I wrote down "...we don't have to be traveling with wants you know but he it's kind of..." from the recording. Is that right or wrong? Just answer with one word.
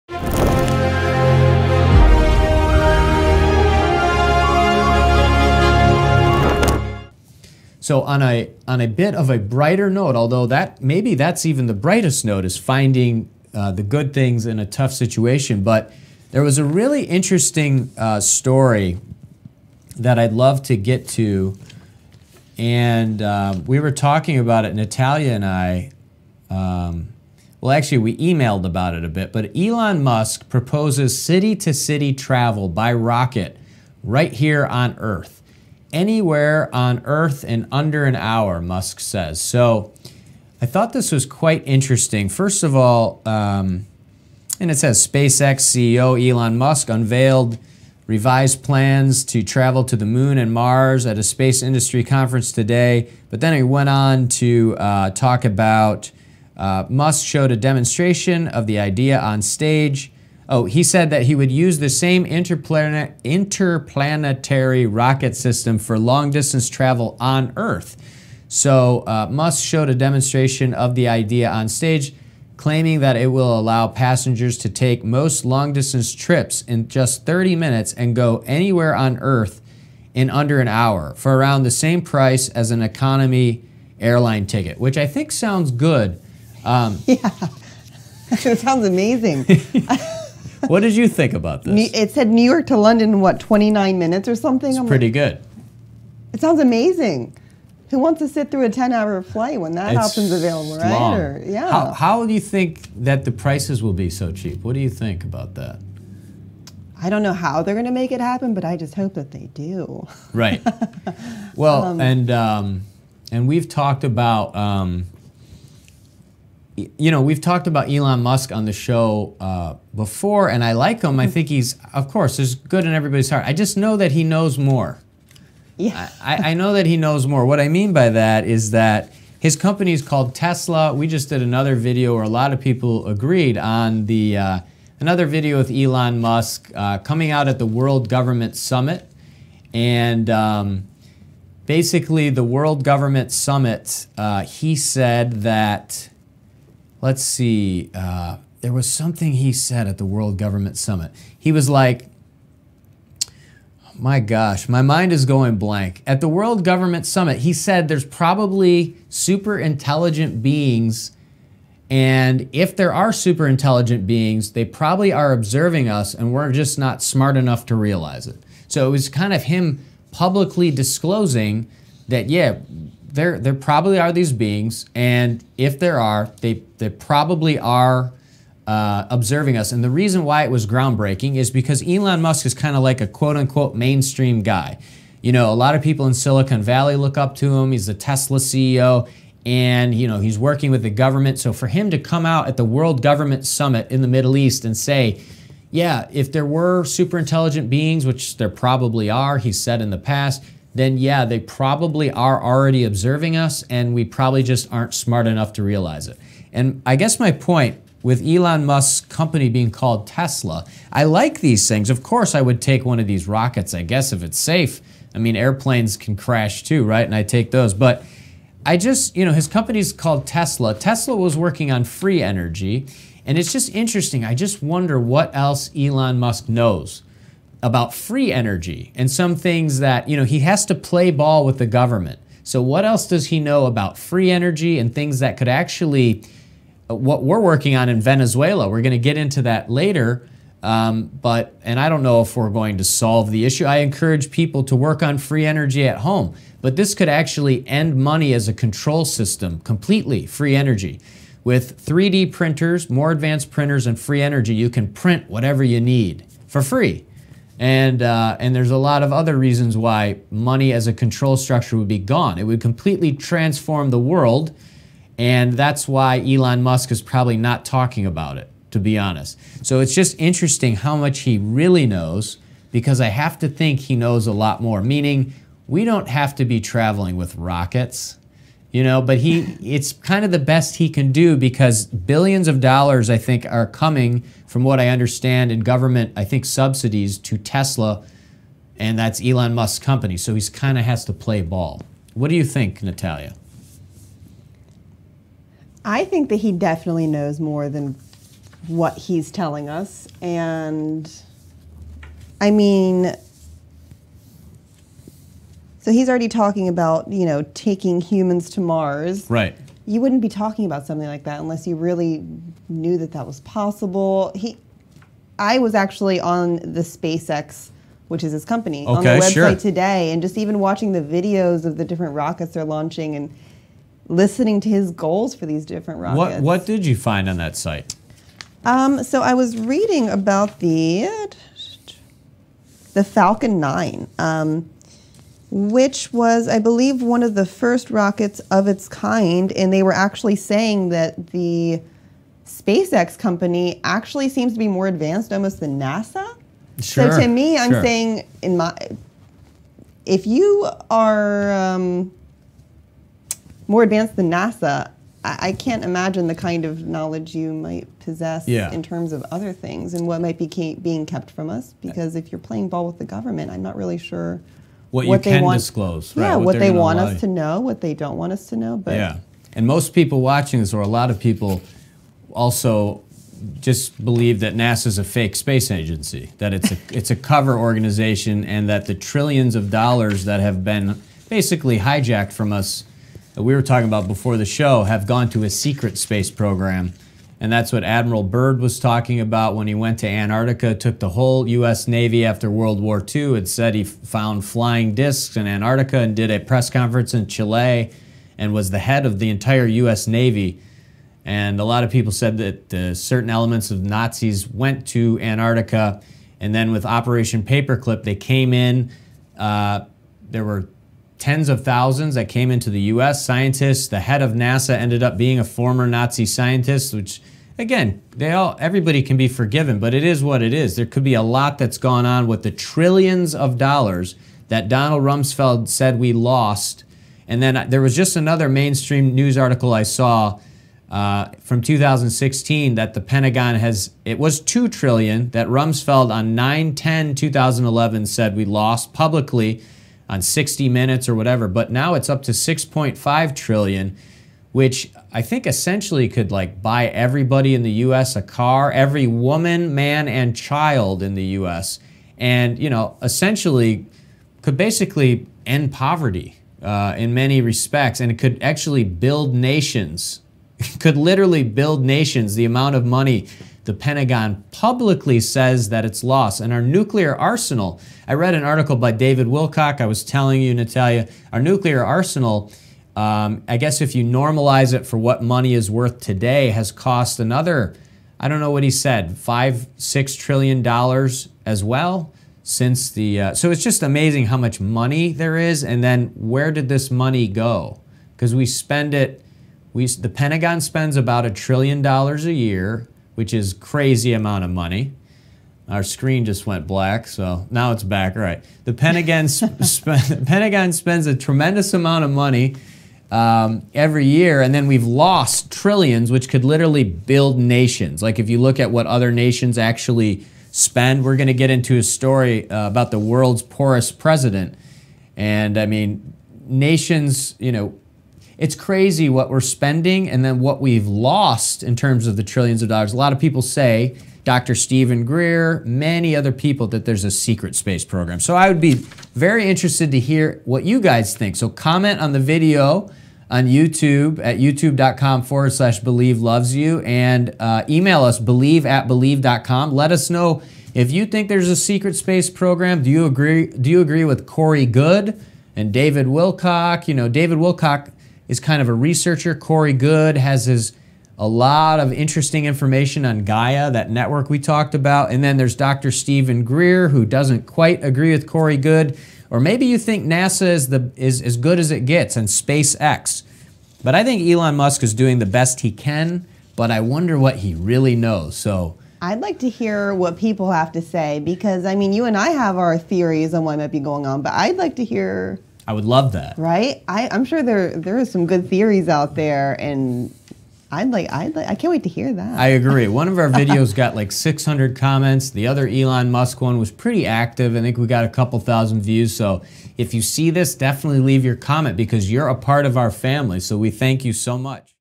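wrong.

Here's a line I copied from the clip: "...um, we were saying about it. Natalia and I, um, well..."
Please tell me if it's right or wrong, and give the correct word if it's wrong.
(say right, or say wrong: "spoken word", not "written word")
wrong: "talking", not "saying".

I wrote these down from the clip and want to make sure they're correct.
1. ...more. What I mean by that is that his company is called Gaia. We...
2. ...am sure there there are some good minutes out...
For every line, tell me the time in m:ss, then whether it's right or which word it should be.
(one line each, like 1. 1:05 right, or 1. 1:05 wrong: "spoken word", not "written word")
1. 2:07 wrong: "Tesla", not "Gaia"
2. 9:37 wrong: "theories", not "minutes".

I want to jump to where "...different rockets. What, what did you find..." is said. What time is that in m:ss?
5:25.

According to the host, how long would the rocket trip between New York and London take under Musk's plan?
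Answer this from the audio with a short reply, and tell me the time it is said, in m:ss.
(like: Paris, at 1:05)
29 minutes, at 1:33.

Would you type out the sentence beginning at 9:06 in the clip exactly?
You know, David Wilcock is kind of a researcher.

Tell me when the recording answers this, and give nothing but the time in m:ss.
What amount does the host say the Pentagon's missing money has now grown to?
7:22.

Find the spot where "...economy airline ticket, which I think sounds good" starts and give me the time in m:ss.
1:22.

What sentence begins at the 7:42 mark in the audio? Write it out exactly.
The amount of money the Pentagon publicly says that it's lost.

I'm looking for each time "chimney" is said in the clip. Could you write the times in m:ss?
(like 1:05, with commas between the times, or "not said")
not said.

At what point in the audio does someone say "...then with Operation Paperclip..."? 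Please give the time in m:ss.
6:46.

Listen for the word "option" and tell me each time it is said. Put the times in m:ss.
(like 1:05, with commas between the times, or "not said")
1:40.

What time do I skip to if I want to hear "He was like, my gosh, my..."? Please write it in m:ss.
2:31.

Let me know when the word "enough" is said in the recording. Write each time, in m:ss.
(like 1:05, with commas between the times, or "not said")
2:47, 3:25.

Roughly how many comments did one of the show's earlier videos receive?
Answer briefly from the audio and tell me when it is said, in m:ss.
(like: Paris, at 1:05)
600, at 9:44.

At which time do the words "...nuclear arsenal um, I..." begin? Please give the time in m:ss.
7:51.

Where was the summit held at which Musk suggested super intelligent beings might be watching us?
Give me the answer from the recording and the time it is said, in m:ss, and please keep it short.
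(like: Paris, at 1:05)
Middle East, at 3:14.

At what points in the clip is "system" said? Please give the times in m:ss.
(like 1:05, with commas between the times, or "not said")
1:05, 4:09.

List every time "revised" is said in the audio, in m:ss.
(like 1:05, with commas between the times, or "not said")
0:48.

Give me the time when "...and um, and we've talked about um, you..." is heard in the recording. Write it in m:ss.
1:52.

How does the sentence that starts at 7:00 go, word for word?
There could be a lot that's gone on with the trillions of dollars that Donald Rumsfeld said we lost.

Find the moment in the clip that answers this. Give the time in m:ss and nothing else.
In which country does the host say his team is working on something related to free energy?
3:58.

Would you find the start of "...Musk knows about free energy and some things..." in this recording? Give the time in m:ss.
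3:46.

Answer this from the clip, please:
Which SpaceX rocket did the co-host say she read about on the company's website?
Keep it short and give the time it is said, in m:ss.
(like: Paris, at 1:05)
Falcon 9, at 5:33.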